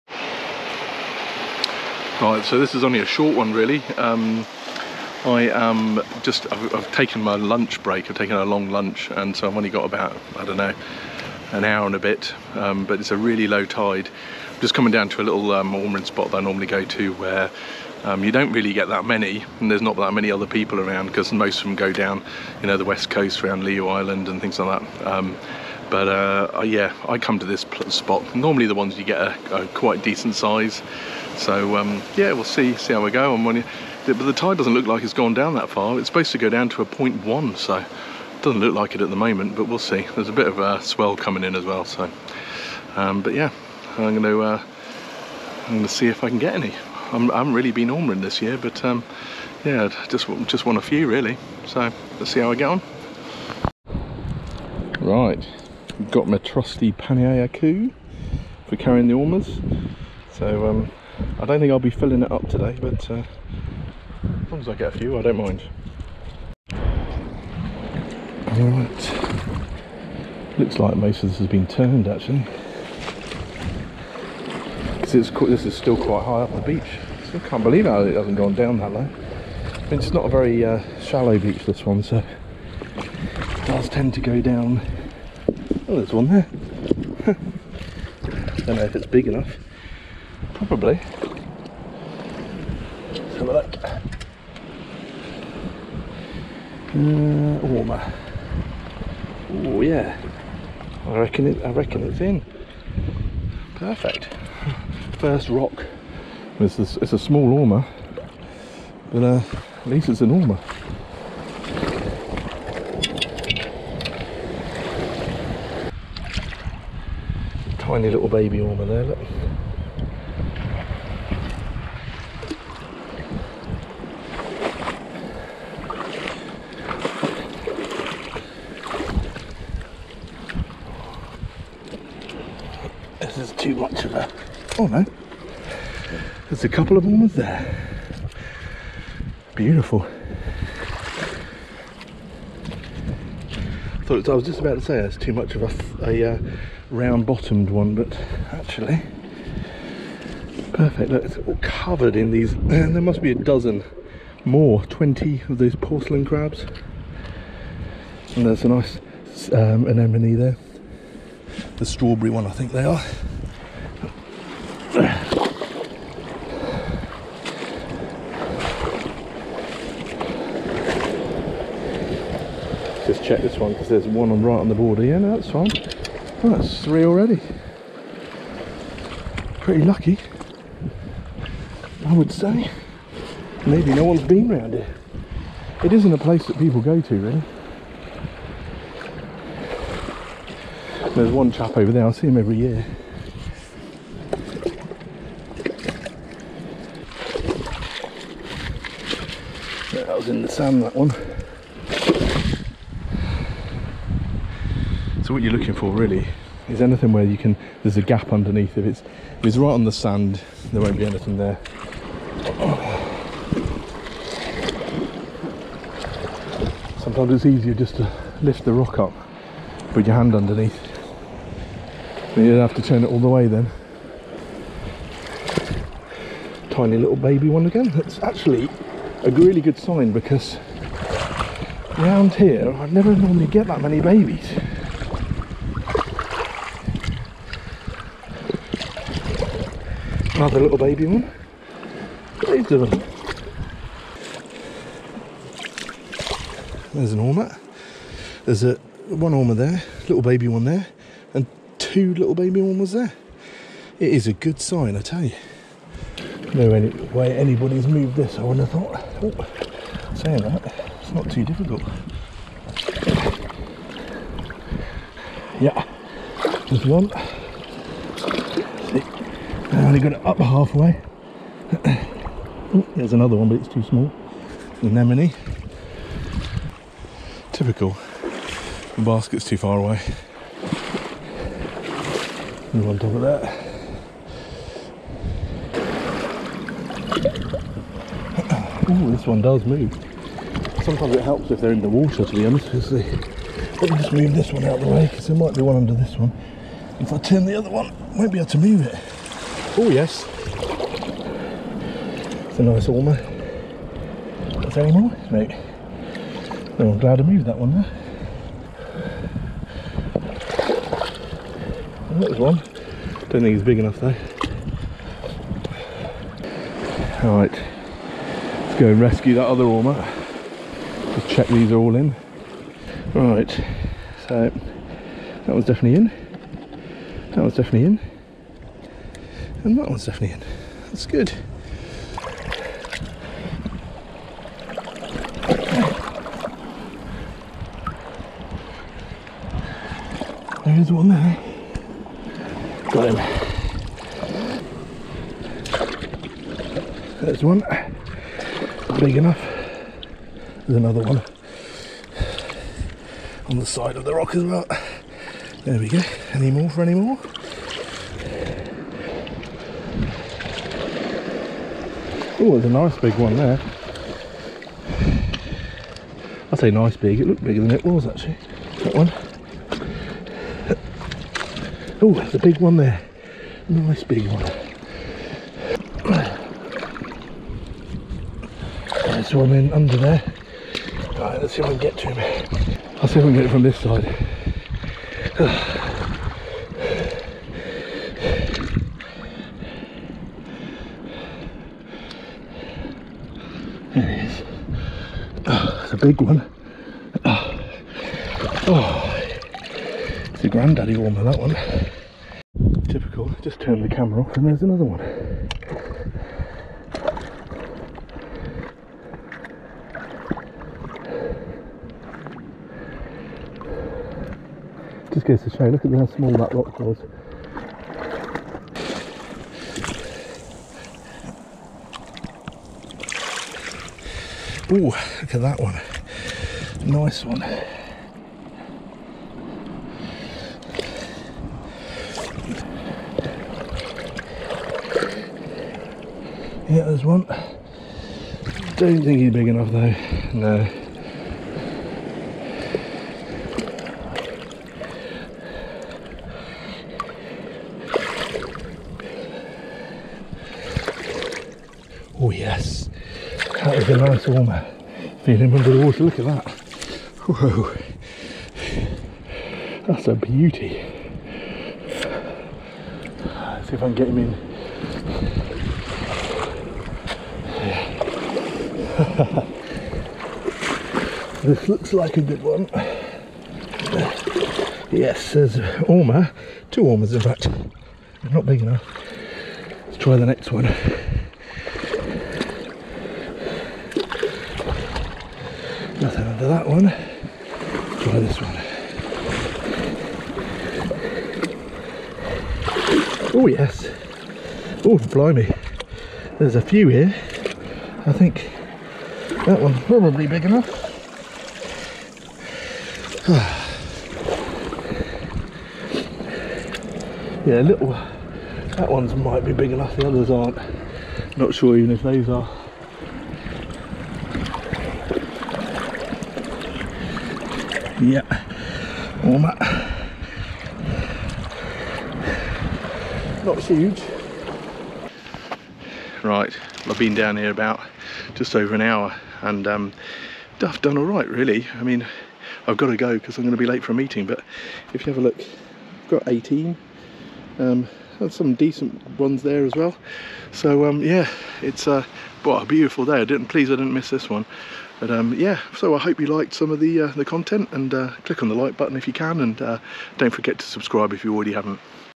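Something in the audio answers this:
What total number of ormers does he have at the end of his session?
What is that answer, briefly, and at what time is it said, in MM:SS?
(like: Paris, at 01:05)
18, at 08:56.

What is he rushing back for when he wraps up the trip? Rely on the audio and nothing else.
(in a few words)
a meeting.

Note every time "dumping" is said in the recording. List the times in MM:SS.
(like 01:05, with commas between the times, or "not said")
not said.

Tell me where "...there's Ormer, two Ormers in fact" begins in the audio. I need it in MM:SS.
07:55.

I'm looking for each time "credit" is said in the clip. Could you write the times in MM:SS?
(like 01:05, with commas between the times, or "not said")
not said.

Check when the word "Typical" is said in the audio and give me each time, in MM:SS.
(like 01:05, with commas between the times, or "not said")
04:37, 06:42.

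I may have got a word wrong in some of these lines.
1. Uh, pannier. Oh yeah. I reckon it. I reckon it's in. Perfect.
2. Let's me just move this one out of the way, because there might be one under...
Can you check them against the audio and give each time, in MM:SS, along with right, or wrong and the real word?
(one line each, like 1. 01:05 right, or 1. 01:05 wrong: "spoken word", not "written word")
1. 01:36 wrong: "ormer", not "pannier"
2. 04:52 right.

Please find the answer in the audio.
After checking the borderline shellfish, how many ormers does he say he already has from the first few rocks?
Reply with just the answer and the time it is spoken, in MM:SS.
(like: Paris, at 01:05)
3, at 02:56.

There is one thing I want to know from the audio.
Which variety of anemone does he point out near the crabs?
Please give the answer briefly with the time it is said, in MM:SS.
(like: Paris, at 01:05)
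strawberry, at 02:41.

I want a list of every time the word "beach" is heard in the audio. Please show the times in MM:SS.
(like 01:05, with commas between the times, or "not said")
01:16, 01:21.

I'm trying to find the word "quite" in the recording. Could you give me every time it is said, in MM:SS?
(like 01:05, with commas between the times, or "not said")
00:29, 01:15.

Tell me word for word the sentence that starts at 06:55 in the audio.
Just goes to show, look at how small that rock was.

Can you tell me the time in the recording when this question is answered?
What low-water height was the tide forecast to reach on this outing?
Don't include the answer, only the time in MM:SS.
00:36.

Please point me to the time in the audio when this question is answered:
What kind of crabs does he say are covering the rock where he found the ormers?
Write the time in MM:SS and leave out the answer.
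02:35.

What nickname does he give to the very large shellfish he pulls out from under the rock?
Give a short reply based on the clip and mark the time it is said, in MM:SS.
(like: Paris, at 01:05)
granddaddy ormer, at 06:40.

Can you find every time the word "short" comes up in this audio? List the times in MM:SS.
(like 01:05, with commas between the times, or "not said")
00:03.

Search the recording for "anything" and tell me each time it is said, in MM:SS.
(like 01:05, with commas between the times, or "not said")
03:26, 03:31.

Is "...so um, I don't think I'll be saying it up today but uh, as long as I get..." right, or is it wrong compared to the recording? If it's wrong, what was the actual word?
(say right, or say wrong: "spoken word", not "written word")
wrong: "filling", not "saying".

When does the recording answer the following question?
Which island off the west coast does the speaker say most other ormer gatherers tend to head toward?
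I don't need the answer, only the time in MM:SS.
00:23.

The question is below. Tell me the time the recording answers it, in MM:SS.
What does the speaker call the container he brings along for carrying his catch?
00:56.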